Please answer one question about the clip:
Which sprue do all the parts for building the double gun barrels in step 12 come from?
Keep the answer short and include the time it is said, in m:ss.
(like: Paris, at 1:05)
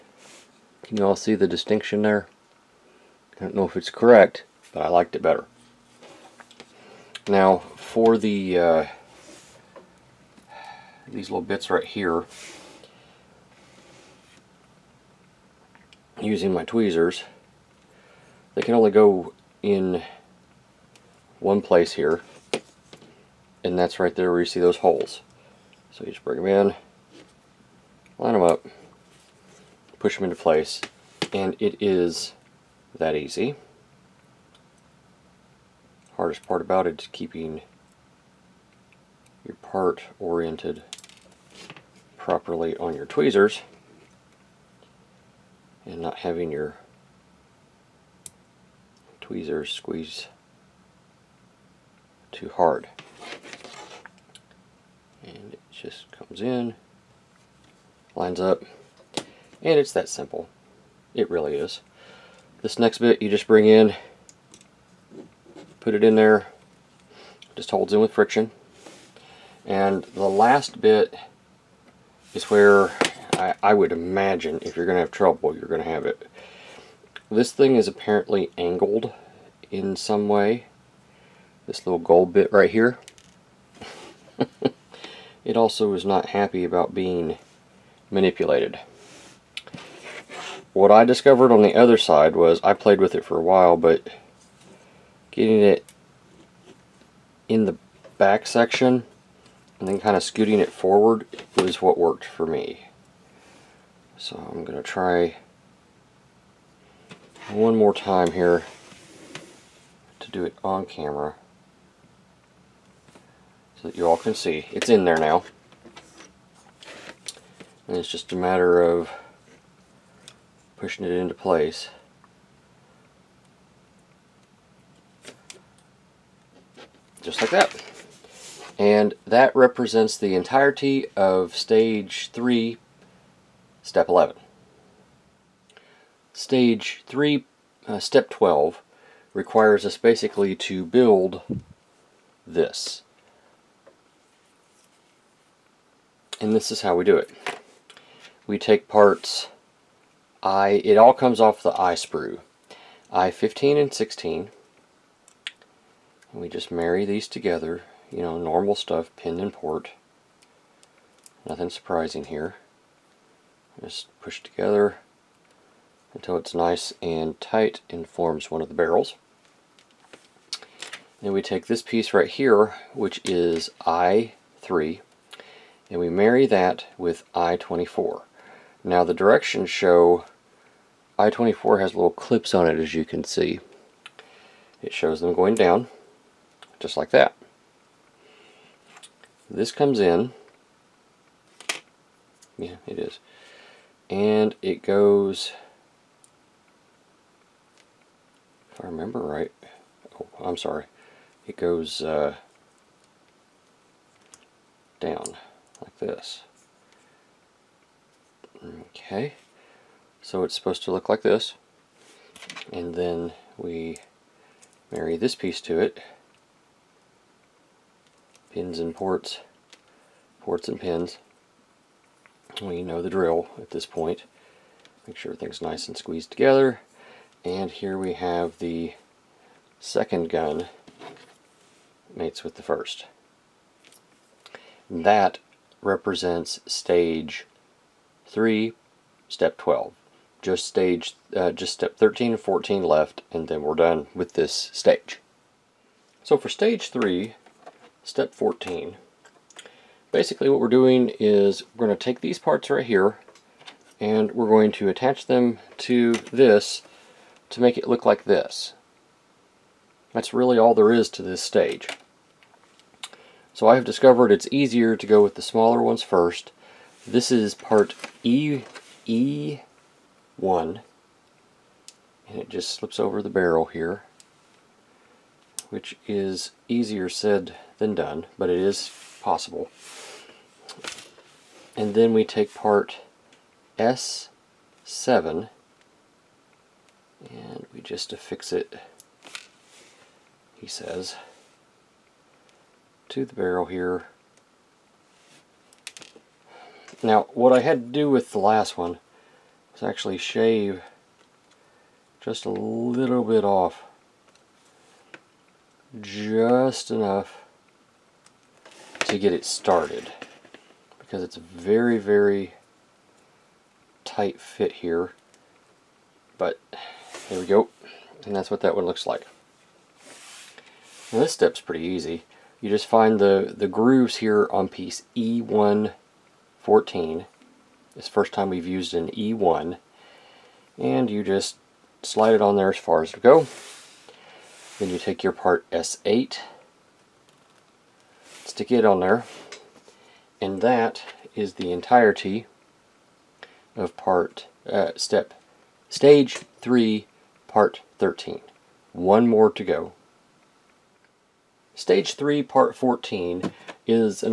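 I sprue, at 2:31.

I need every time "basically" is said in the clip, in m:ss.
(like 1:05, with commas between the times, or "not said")
2:19, 4:10.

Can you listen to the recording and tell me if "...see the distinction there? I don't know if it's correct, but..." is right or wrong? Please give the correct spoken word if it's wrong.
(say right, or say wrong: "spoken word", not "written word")
right.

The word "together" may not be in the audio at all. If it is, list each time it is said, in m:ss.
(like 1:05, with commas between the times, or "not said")
2:37, 2:44, 3:46.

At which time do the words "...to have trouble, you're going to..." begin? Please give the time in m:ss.
1:14.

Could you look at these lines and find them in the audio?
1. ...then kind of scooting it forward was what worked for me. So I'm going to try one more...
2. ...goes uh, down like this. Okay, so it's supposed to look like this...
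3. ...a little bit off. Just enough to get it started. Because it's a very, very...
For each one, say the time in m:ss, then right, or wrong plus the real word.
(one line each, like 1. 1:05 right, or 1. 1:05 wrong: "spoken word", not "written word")
1. 1:39 right
2. 3:21 right
3. 5:02 right.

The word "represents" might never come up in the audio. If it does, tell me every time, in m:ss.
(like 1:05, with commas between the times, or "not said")
2:09, 3:55.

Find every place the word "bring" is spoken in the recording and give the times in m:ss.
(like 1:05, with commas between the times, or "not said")
0:26, 1:03.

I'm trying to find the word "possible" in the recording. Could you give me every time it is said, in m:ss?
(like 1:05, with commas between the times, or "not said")
4:39.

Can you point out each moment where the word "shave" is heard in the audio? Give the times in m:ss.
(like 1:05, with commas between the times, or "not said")
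5:00.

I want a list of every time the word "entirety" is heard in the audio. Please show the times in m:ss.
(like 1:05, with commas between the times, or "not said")
2:10, 5:41.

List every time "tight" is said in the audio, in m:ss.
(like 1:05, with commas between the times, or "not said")
2:47, 5:14.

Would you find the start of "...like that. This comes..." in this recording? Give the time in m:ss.
3:06.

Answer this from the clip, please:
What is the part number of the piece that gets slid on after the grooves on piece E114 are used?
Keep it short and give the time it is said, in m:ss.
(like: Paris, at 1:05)
S8, at 5:35.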